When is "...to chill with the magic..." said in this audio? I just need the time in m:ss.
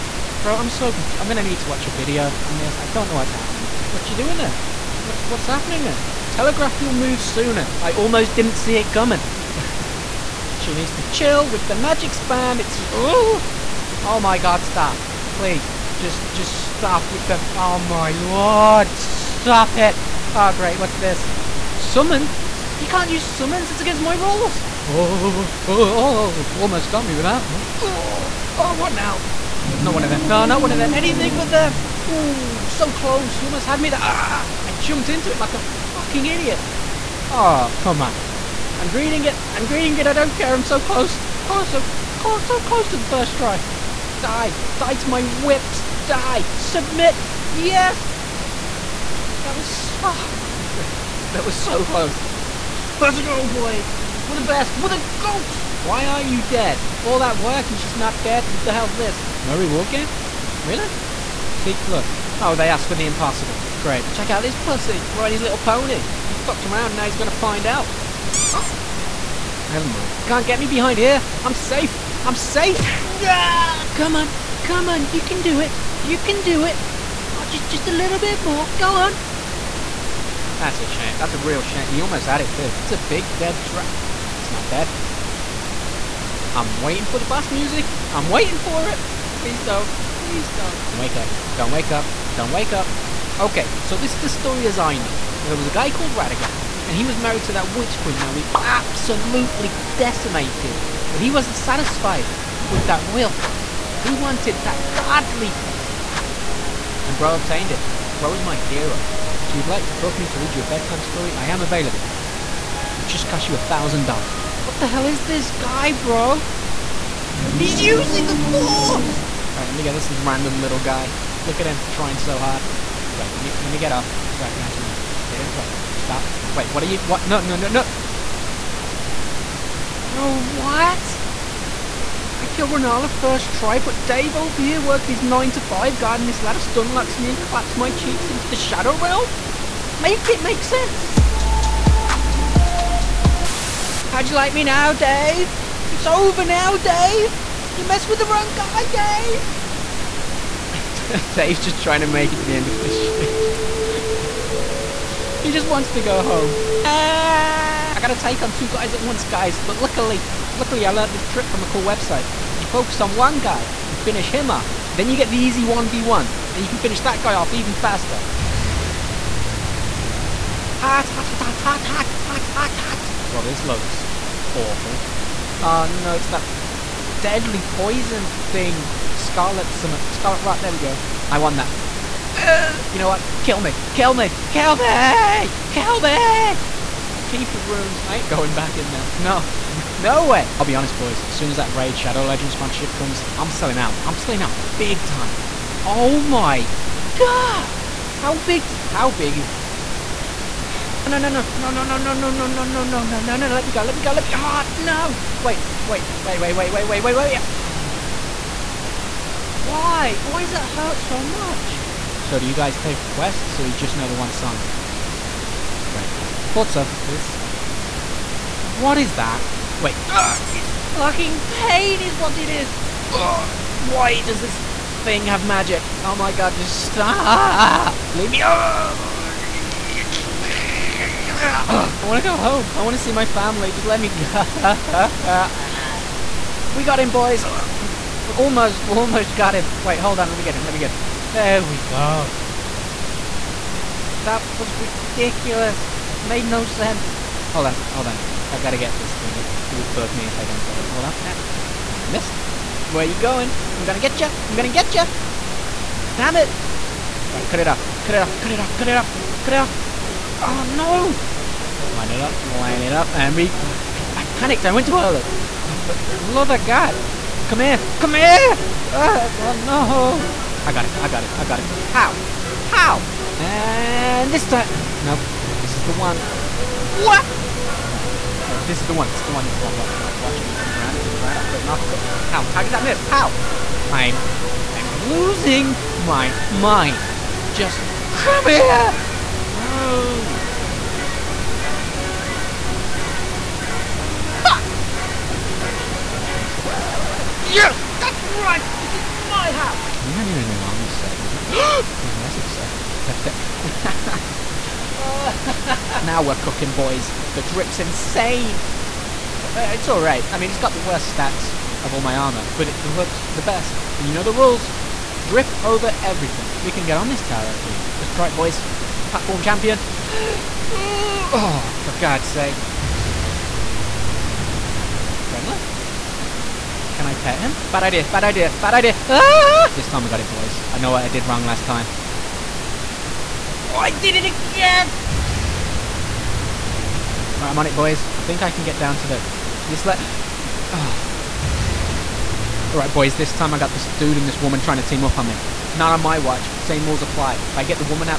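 0:10.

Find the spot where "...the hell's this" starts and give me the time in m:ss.
0:58.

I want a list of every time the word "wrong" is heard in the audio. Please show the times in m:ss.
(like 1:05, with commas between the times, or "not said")
2:28, 5:31.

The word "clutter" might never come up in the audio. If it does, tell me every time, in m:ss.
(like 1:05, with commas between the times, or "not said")
not said.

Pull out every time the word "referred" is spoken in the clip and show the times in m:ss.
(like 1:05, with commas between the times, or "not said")
not said.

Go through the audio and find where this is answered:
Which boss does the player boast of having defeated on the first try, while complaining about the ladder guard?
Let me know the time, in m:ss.
2:12.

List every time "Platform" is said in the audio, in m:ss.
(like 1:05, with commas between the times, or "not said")
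5:19.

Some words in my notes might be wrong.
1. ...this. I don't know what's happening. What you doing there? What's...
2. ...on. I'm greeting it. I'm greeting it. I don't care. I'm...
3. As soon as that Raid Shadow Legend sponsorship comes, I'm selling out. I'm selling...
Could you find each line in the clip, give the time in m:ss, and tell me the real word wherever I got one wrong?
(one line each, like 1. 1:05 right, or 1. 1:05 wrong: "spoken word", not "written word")
1. 0:02 right
2. 0:38 right
3. 3:11 right.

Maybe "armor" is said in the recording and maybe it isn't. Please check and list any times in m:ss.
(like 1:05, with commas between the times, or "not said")
5:00, 5:12.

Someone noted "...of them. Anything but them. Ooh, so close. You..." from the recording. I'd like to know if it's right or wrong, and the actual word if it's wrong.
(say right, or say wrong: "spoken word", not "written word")
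right.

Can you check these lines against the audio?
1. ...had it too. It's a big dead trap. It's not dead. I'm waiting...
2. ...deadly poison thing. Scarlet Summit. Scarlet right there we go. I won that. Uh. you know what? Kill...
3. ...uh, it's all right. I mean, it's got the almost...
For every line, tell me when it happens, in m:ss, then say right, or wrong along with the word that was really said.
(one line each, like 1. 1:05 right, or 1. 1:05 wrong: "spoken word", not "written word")
1. 1:22 right
2. 2:57 right
3. 5:09 wrong: "worst", not "almost".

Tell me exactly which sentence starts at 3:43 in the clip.
Ugh, why does this thing have magic?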